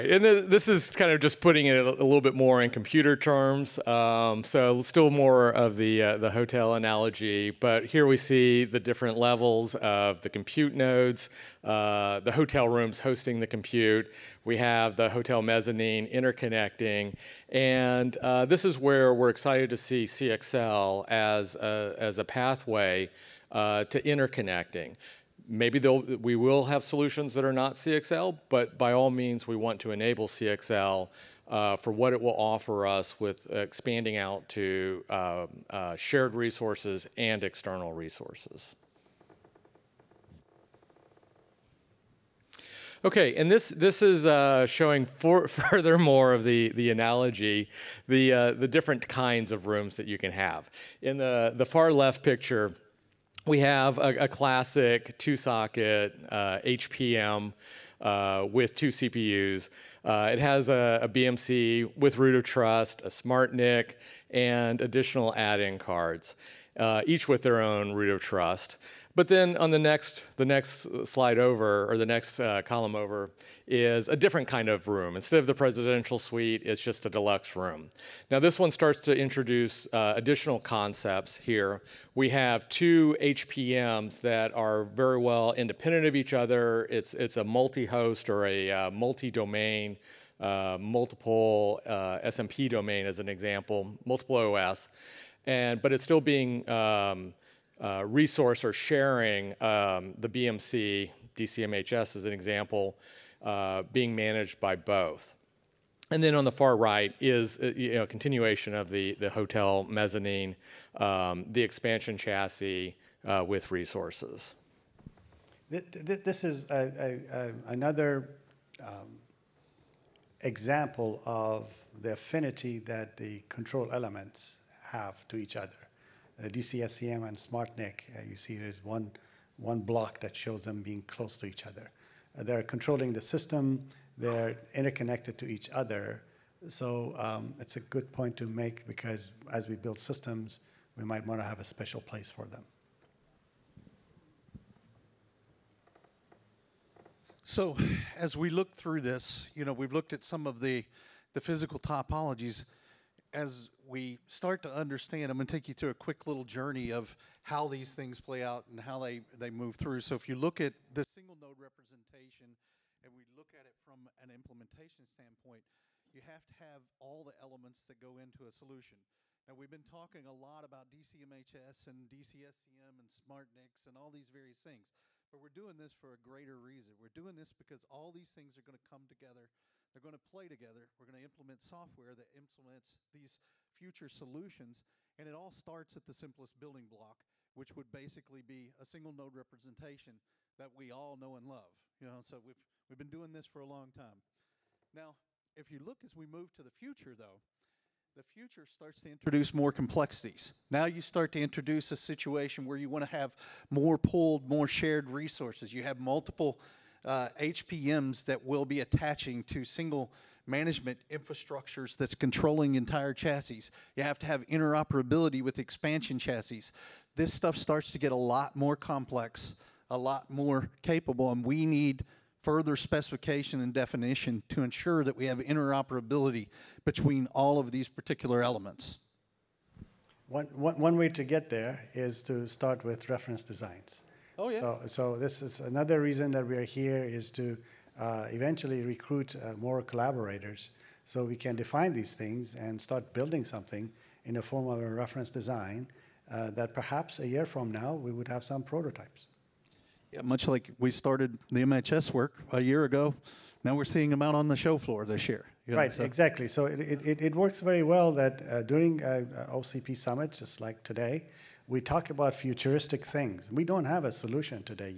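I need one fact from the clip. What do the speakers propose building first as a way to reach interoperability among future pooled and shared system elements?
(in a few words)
reference designs.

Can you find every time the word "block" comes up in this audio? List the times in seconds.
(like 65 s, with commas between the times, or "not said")
129 s, 186 s.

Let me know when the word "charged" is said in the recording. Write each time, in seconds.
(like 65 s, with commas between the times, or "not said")
not said.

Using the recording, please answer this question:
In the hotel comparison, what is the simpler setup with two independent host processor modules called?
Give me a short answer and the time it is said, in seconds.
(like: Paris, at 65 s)
deluxe room, at 77 s.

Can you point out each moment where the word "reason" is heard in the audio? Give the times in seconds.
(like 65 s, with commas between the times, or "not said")
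176 s, 236 s.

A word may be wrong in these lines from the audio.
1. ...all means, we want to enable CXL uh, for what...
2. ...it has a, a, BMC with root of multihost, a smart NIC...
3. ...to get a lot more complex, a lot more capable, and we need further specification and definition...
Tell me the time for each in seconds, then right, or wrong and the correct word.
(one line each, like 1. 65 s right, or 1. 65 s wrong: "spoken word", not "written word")
1. 28 s right
2. 60 s wrong: "trust", not "multihost"
3. 217 s right.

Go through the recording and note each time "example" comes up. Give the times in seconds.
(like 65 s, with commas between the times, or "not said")
93 s, 102 s, 120 s.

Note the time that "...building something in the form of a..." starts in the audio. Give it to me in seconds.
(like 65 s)
243 s.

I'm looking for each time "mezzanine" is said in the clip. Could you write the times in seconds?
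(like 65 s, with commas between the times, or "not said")
15 s, 109 s.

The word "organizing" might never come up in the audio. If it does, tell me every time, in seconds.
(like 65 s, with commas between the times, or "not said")
not said.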